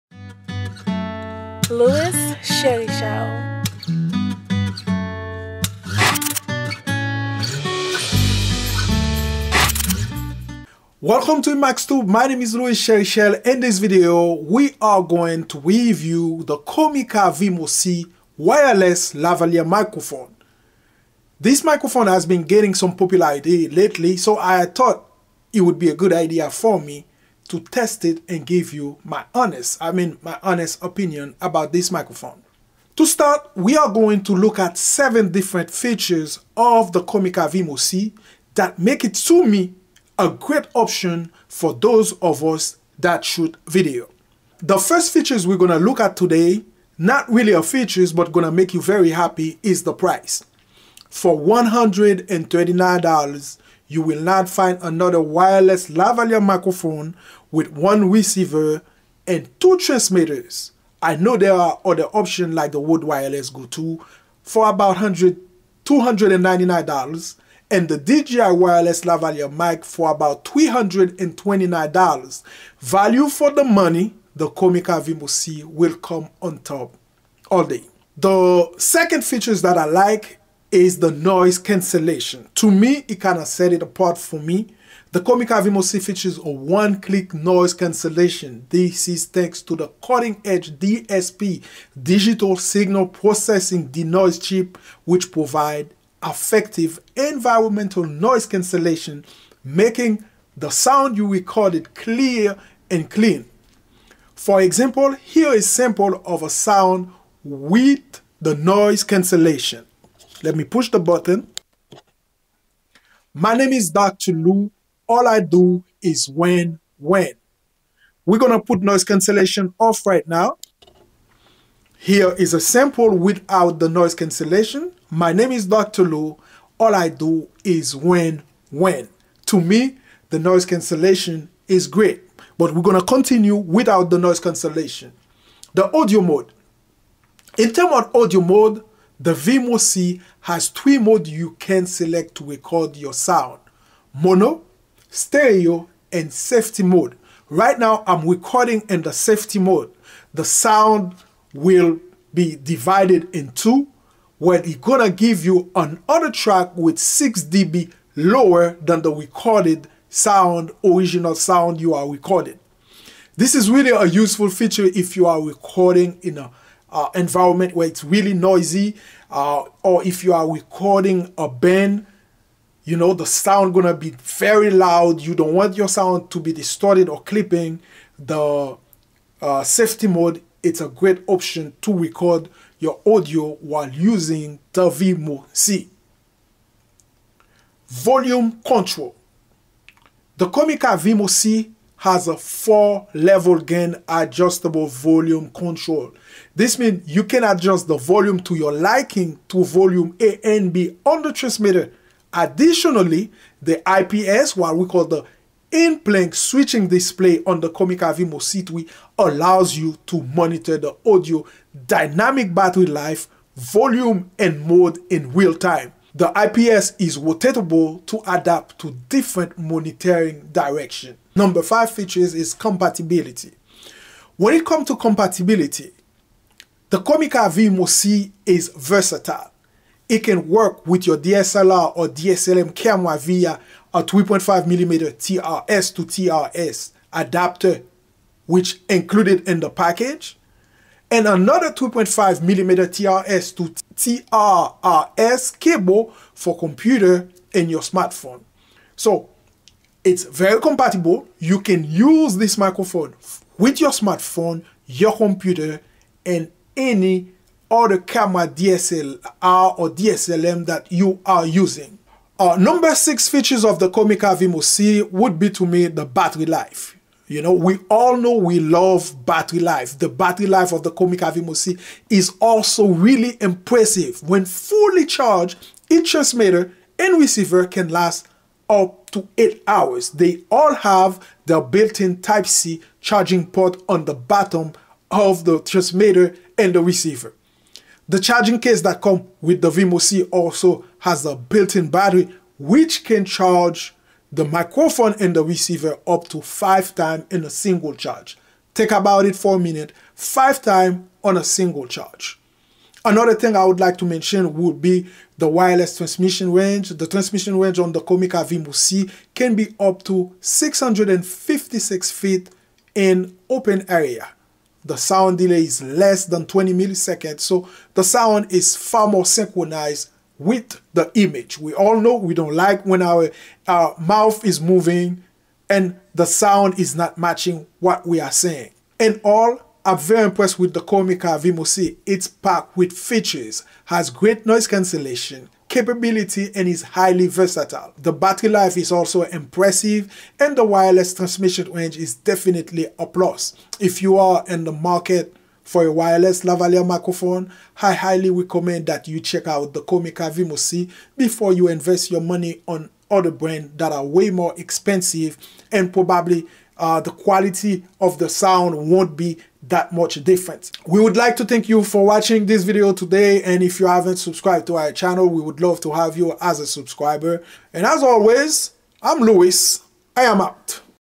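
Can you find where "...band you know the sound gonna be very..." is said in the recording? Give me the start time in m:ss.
2:51.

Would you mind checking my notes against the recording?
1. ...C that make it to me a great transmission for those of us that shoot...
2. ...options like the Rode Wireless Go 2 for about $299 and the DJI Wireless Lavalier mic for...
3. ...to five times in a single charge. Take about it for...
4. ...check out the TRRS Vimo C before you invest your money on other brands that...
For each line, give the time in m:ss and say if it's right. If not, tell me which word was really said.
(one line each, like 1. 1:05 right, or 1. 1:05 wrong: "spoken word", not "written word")
1. 0:37 wrong: "option", not "transmission"
2. 1:02 right
3. 4:56 right
4. 5:49 wrong: "Comica", not "TRRS".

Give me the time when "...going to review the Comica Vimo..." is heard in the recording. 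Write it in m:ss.
0:15.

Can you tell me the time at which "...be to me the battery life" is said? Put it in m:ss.
4:25.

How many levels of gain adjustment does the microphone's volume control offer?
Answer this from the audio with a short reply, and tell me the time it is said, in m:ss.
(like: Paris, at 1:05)
4, at 3:12.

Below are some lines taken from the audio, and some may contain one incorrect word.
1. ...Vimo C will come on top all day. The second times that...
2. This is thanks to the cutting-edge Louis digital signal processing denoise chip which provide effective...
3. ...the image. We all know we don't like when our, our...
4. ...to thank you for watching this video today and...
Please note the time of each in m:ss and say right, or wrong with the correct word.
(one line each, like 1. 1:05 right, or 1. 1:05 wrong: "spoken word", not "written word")
1. 1:14 wrong: "features", not "times"
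2. 1:28 wrong: "DSP", not "Louis"
3. 5:20 right
4. 6:01 right.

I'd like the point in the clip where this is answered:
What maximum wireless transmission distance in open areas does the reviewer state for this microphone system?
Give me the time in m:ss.
5:10.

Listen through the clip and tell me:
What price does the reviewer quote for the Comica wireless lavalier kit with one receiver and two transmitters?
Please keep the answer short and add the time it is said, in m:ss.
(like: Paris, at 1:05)
$139, at 0:51.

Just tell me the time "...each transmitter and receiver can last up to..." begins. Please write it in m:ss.
4:35.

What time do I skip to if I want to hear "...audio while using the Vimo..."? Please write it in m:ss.
3:03.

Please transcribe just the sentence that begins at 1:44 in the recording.
For example, here is sample of a sound with the noise cancellation.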